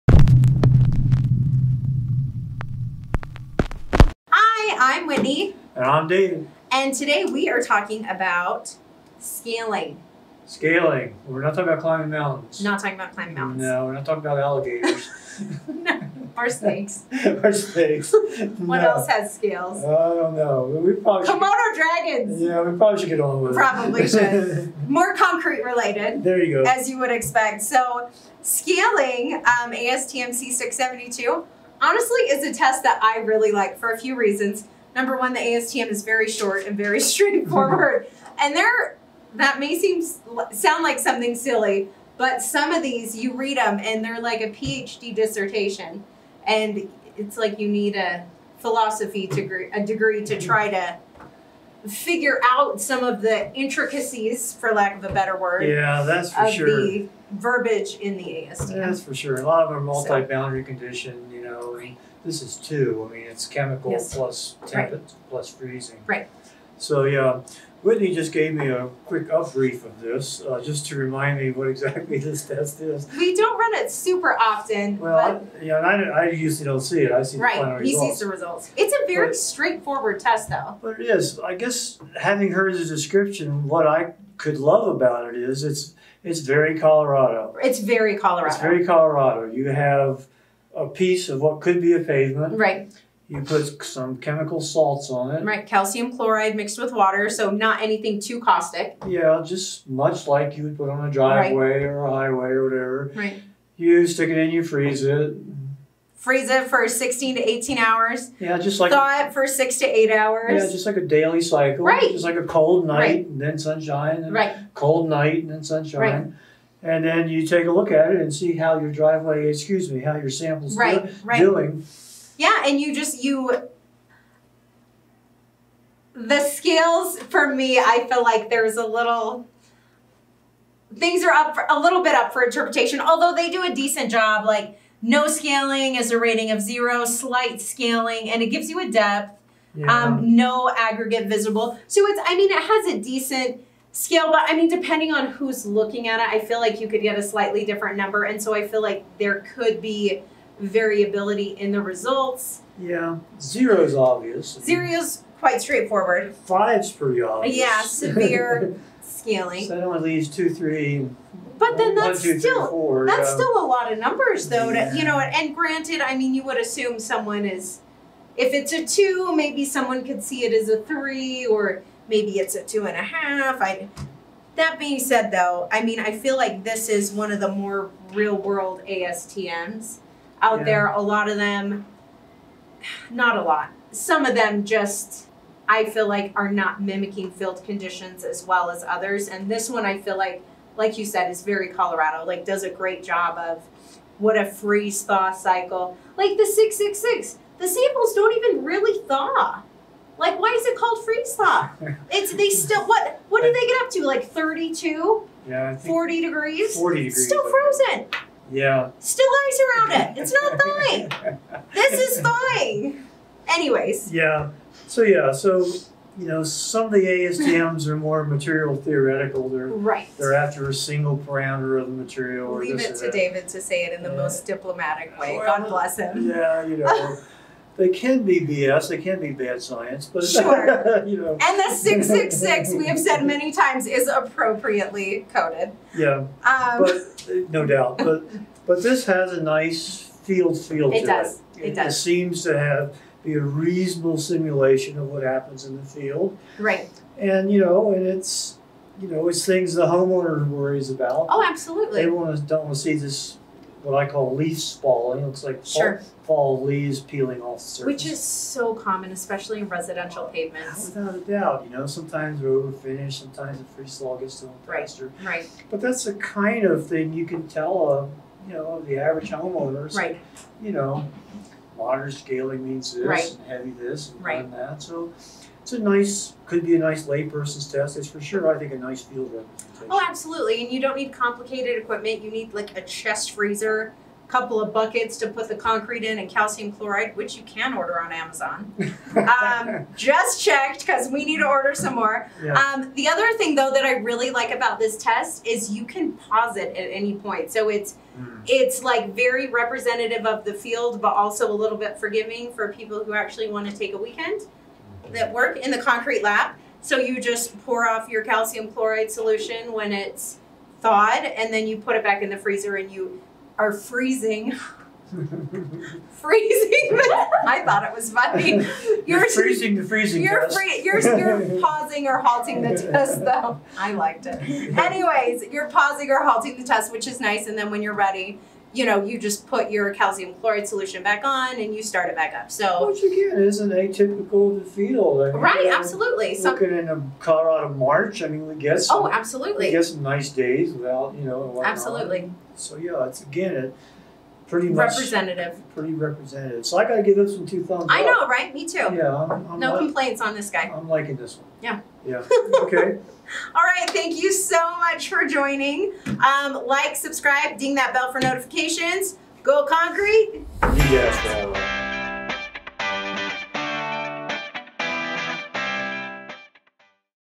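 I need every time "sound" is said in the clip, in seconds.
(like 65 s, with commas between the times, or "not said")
40 s.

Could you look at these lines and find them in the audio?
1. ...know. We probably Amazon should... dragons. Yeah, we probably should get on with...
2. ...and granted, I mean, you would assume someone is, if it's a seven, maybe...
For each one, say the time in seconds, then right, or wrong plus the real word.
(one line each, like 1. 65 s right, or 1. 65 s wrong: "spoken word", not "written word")
1. 20 s wrong: "Komodo", not "Amazon"
2. 165 s wrong: "two", not "seven".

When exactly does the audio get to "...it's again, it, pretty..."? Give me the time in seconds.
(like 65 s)
343 s.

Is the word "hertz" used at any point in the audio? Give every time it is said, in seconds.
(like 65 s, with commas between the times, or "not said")
not said.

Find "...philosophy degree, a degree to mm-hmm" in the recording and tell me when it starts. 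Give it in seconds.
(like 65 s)
48 s.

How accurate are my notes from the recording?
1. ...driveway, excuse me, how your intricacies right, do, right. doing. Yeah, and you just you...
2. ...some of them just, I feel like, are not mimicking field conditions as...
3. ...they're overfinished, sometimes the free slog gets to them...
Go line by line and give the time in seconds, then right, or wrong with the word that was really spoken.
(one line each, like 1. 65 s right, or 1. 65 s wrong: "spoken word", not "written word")
1. 118 s wrong: "samples", not "intricacies"
2. 183 s right
3. 262 s right.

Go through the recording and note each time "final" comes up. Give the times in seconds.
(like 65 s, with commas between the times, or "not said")
77 s.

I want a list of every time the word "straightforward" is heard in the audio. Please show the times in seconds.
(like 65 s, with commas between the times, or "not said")
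36 s, 79 s, 155 s.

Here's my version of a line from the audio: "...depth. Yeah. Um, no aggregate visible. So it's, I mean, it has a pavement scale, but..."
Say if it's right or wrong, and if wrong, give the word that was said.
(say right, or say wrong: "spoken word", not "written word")
wrong: "decent", not "pavement".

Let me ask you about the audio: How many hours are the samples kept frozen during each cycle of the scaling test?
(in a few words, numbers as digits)
16 to 18 hours.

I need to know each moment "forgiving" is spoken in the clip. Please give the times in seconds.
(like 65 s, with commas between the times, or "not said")
301 s.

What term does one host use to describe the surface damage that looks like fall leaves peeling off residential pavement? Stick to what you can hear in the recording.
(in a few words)
leaf spalling.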